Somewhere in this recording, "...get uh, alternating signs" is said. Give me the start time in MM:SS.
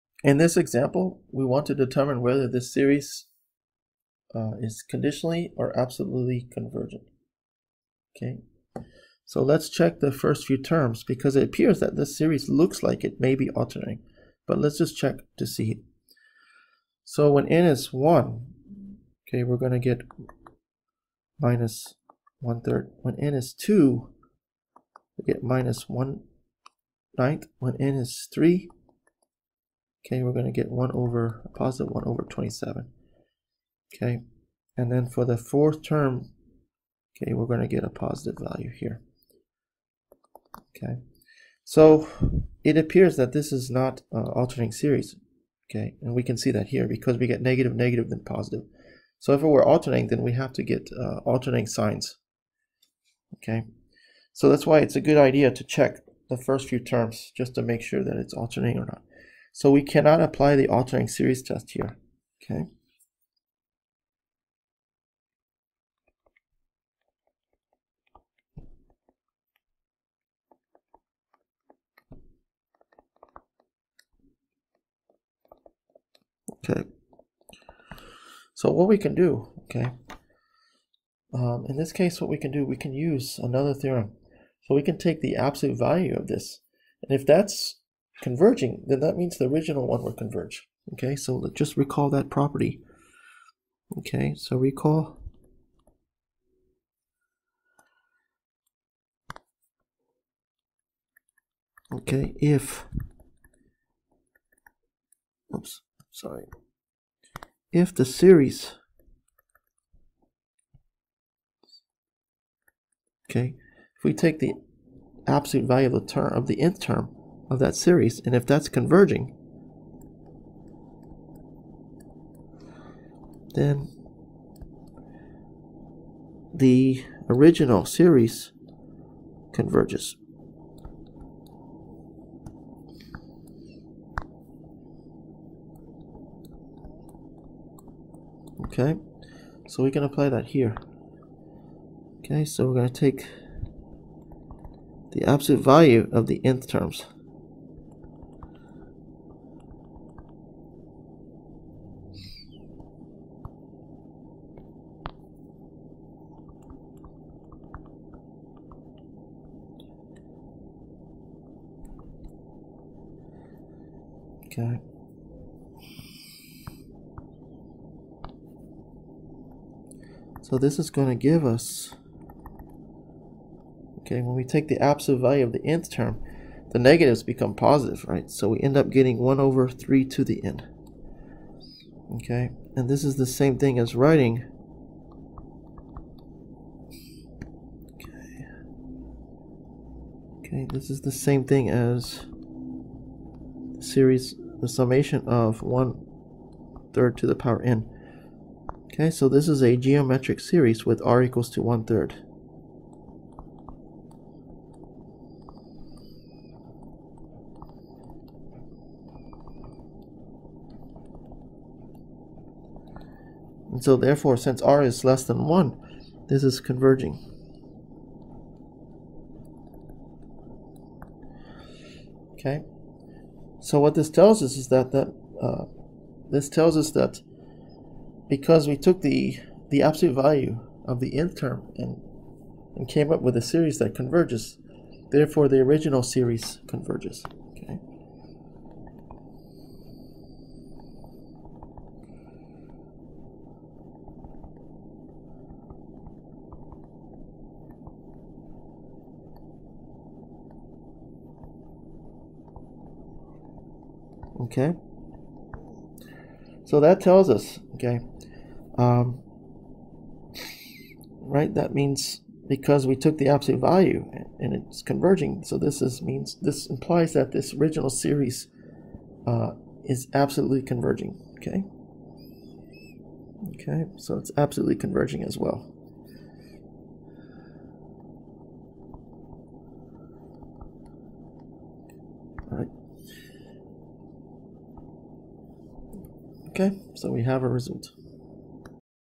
00:50.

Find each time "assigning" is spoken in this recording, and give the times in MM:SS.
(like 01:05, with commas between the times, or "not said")
not said.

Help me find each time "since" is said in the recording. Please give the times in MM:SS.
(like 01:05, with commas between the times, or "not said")
03:34.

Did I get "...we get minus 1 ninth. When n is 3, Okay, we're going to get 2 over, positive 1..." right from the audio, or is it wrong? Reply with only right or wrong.
wrong.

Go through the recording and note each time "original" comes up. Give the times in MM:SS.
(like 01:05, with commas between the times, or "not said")
01:29, 02:07, 03:55, 04:27.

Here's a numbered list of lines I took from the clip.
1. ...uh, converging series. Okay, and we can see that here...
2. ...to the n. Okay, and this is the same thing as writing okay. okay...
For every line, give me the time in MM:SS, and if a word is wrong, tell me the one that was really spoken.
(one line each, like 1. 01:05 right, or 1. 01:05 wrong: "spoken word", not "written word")
1. 00:44 wrong: "alternating", not "converging"
2. 03:00 right.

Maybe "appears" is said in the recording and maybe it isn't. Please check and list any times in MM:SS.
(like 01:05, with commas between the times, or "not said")
00:11, 00:42.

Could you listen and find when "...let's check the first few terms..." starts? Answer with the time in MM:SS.
00:09.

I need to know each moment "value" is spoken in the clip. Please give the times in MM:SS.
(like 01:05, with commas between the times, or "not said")
00:38, 01:25, 01:55, 02:25, 02:55, 03:50, 04:23.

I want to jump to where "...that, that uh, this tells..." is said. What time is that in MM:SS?
03:44.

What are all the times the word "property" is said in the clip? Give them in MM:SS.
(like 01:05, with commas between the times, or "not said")
01:32.